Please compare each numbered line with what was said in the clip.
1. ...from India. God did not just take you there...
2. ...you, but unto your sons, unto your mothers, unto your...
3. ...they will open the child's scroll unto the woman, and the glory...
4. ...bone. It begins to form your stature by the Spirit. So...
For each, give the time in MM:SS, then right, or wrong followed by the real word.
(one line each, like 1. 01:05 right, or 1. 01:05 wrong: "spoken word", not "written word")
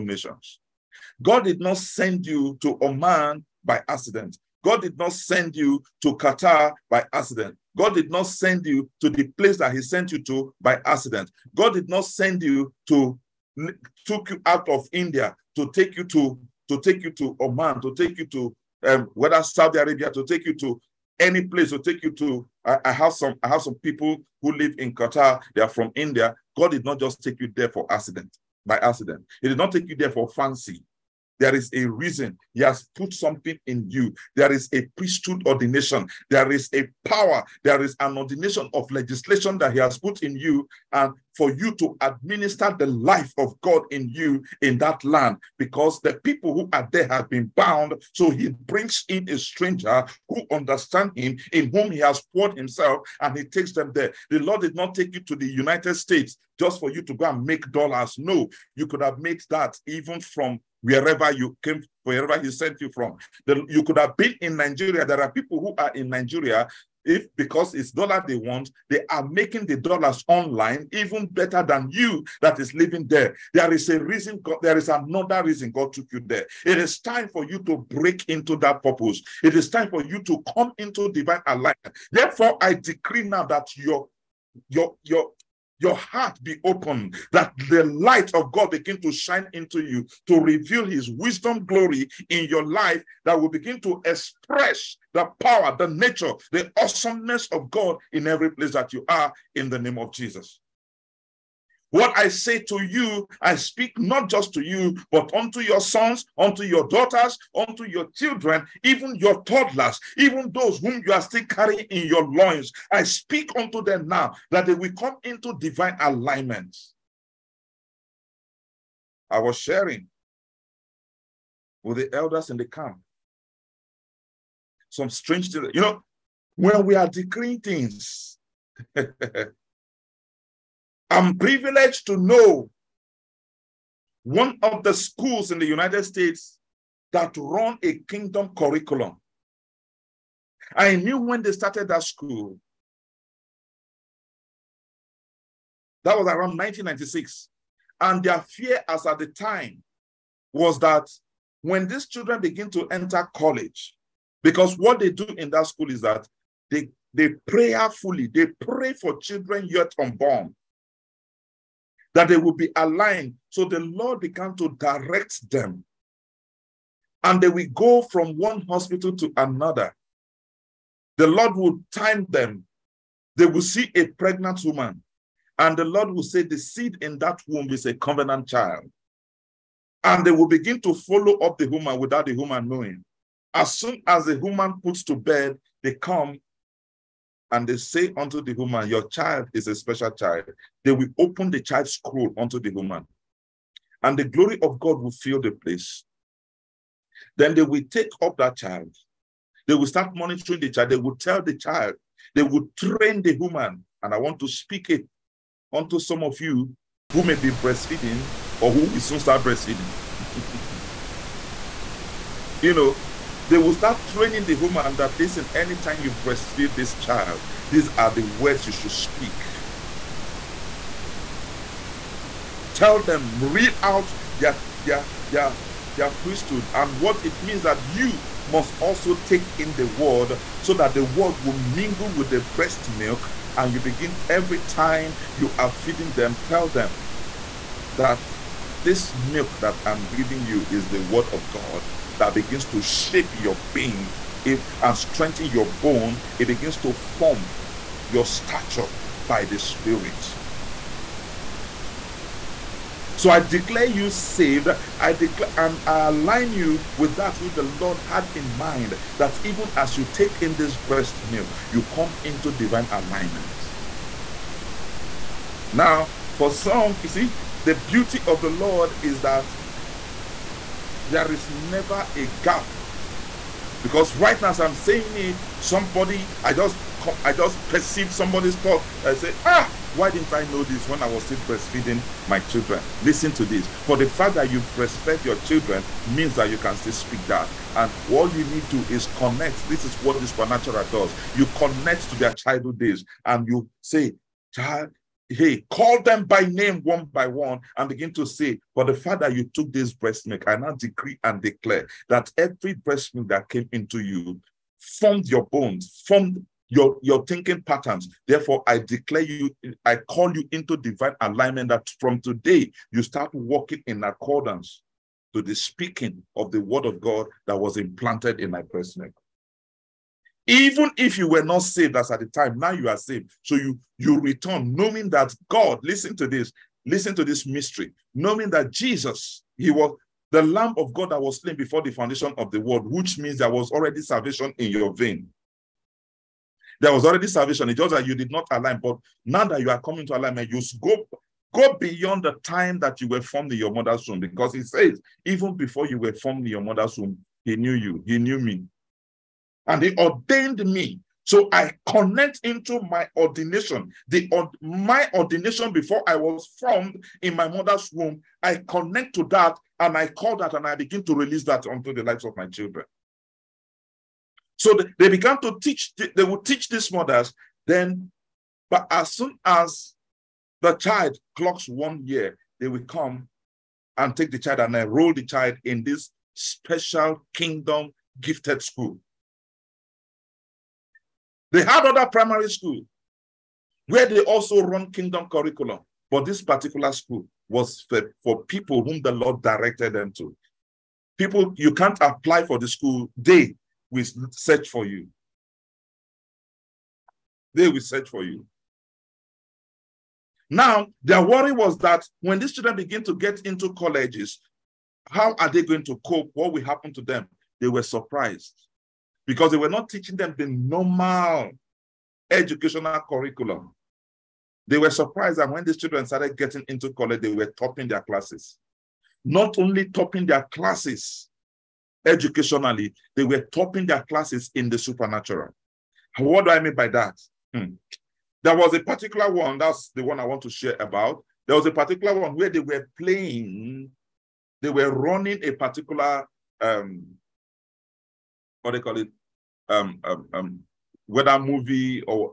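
1. 00:25 right
2. 01:44 wrong: "daughters", not "mothers"
3. 03:10 right
4. 04:05 right.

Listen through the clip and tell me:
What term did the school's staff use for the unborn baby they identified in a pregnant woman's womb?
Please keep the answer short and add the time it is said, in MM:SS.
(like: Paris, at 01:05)
covenant child, at 02:57.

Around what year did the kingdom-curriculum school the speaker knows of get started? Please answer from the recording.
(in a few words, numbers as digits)
1996.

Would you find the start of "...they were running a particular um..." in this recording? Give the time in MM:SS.
07:14.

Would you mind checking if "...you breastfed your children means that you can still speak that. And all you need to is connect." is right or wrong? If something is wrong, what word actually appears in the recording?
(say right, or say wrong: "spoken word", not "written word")
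right.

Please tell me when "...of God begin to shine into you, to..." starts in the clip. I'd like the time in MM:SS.
01:28.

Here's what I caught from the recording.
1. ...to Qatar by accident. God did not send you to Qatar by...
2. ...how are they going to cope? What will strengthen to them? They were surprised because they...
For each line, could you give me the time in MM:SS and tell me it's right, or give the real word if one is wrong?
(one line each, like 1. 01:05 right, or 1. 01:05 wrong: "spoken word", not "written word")
1. 00:02 wrong: "Oman", not "Qatar"
2. 06:45 wrong: "happen", not "strengthen".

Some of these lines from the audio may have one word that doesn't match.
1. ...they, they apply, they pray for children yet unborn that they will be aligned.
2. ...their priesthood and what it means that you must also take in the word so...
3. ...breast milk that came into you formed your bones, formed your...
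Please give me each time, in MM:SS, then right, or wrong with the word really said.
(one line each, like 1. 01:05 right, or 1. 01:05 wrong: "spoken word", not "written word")
1. 02:36 wrong: "prayerfully", not "apply"
2. 03:45 right
3. 05:02 right.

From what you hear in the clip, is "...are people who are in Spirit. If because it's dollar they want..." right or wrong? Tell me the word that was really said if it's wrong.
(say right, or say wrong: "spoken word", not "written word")
wrong: "Nigeria", not "Spirit".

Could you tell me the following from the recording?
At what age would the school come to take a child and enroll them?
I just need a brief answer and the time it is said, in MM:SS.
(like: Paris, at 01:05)
1 year, at 06:11.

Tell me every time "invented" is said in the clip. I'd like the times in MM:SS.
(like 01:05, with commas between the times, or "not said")
not said.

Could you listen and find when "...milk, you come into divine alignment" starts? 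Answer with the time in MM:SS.
04:21.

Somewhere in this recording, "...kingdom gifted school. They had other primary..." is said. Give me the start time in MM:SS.
06:17.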